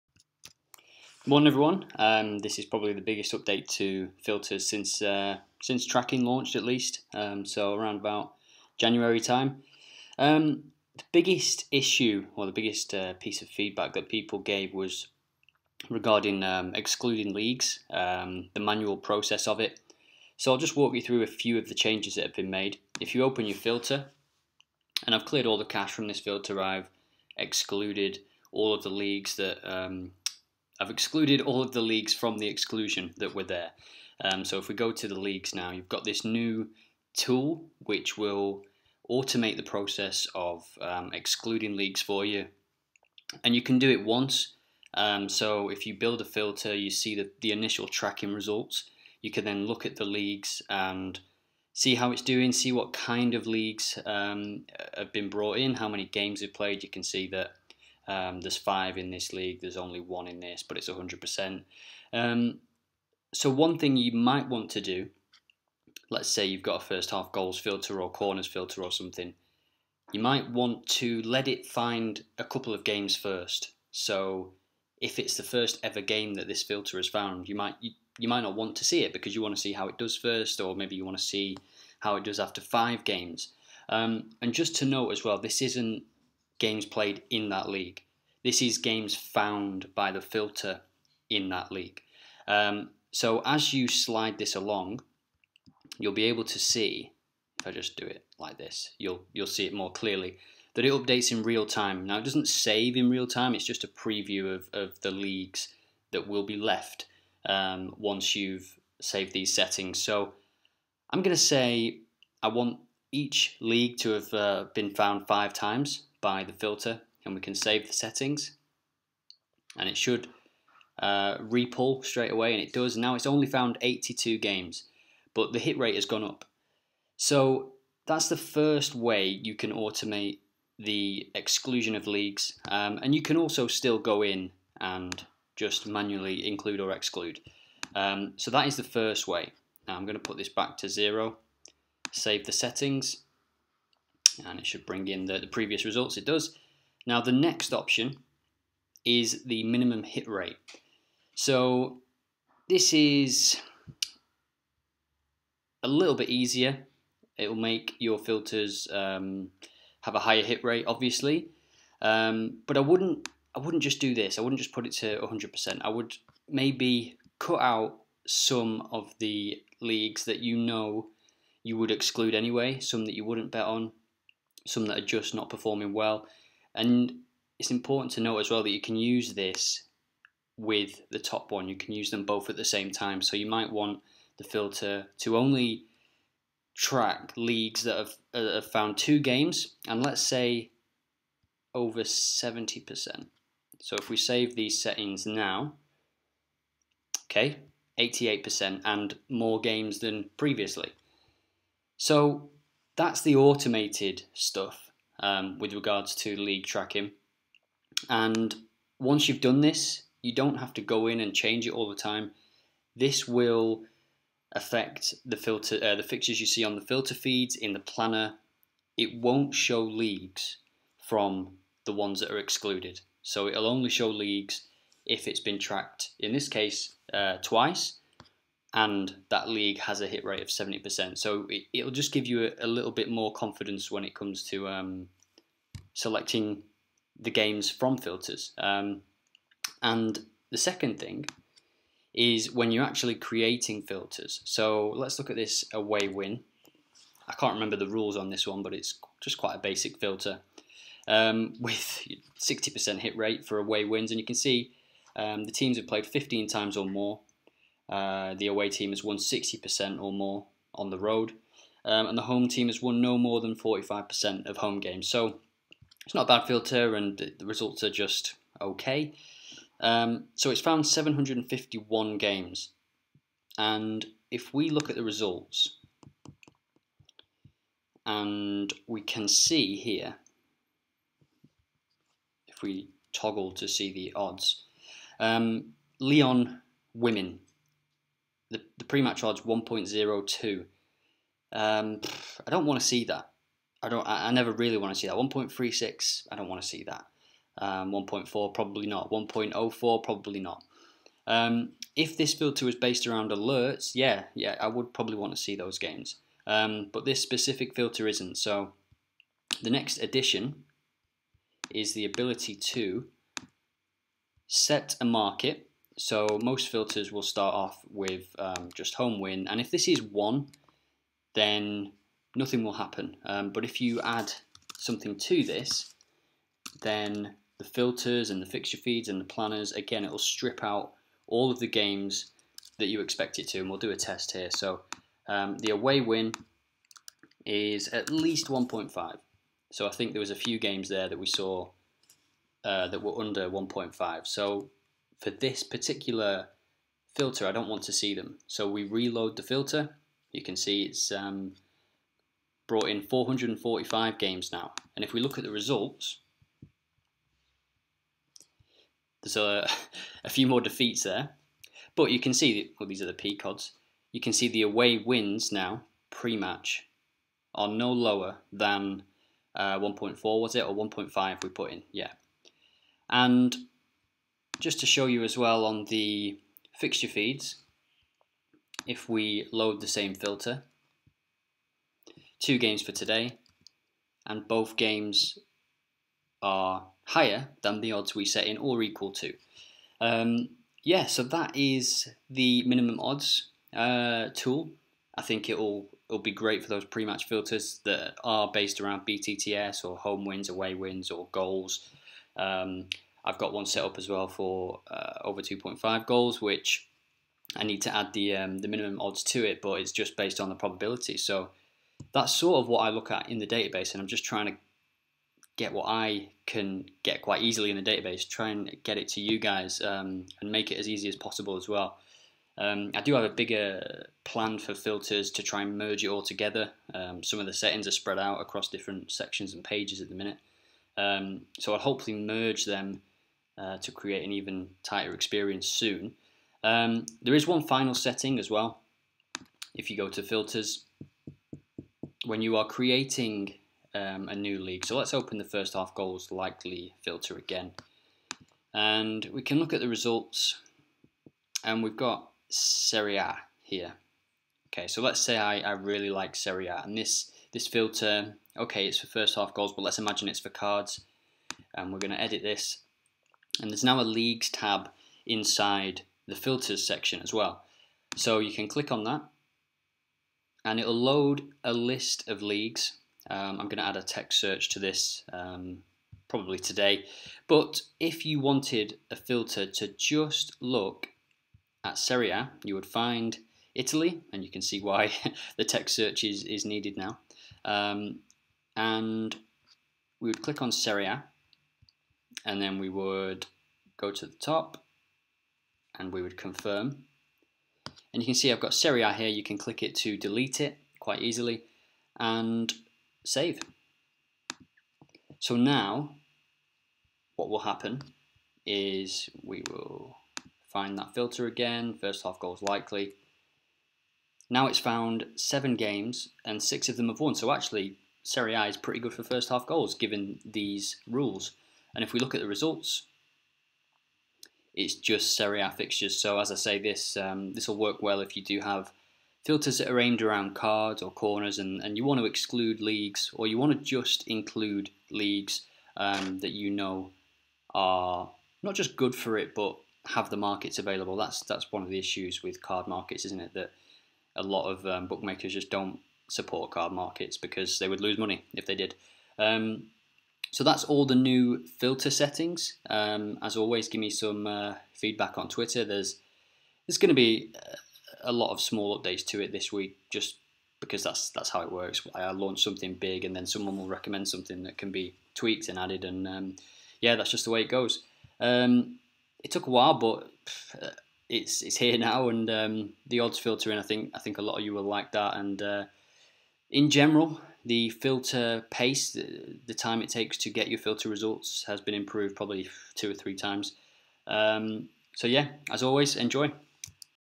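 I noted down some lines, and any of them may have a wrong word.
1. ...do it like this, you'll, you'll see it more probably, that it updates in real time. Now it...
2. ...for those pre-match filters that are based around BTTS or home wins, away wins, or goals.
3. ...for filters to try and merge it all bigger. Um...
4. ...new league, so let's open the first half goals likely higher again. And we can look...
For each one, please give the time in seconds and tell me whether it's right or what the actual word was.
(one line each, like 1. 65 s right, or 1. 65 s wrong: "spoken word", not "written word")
1. 97 s wrong: "clearly", not "probably"
2. 396 s right
3. 424 s wrong: "together", not "bigger"
4. 444 s wrong: "filter", not "higher".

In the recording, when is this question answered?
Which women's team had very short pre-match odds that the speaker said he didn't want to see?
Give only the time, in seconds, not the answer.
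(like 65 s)
285 s.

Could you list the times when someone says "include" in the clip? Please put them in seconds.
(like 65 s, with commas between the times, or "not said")
136 s, 534 s.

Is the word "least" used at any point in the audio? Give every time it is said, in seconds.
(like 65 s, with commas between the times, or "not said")
6 s, 338 s.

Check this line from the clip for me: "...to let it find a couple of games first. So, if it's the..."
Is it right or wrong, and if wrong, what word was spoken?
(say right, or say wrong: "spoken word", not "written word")
right.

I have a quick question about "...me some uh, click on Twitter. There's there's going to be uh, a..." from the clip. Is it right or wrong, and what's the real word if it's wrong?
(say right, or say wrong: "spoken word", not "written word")
wrong: "feedback", not "click".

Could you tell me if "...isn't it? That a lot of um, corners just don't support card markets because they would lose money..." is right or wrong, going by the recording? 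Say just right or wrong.
wrong.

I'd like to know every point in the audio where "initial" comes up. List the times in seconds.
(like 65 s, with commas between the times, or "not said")
47 s.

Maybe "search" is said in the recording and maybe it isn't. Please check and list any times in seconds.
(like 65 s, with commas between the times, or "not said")
474 s, 485 s.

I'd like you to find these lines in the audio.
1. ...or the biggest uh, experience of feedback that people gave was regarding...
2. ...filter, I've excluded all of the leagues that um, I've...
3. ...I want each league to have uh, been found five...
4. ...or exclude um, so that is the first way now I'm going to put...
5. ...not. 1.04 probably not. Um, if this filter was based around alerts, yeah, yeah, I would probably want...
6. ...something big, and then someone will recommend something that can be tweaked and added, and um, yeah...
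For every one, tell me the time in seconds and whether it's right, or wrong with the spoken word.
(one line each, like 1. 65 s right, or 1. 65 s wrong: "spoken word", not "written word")
1. 12 s wrong: "piece", not "experience"
2. 26 s right
3. 112 s right
4. 136 s right
5. 298 s right
6. 562 s right.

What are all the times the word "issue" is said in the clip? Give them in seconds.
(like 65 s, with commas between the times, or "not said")
11 s, 541 s.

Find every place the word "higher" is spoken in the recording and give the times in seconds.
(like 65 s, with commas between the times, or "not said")
160 s, 387 s.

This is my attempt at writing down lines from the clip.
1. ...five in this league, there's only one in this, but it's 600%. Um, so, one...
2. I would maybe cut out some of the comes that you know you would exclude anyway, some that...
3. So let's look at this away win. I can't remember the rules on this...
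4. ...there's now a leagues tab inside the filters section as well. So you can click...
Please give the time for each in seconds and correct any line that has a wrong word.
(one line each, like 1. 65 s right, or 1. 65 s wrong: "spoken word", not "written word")
1. 58 s wrong: "100", not "600"
2. 165 s wrong: "leagues", not "comes"
3. 244 s right
4. 463 s right.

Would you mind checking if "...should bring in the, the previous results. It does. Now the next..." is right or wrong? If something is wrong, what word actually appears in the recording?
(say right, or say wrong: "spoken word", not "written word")
right.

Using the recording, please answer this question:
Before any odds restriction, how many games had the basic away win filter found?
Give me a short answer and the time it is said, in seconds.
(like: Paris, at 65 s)
751, at 270 s.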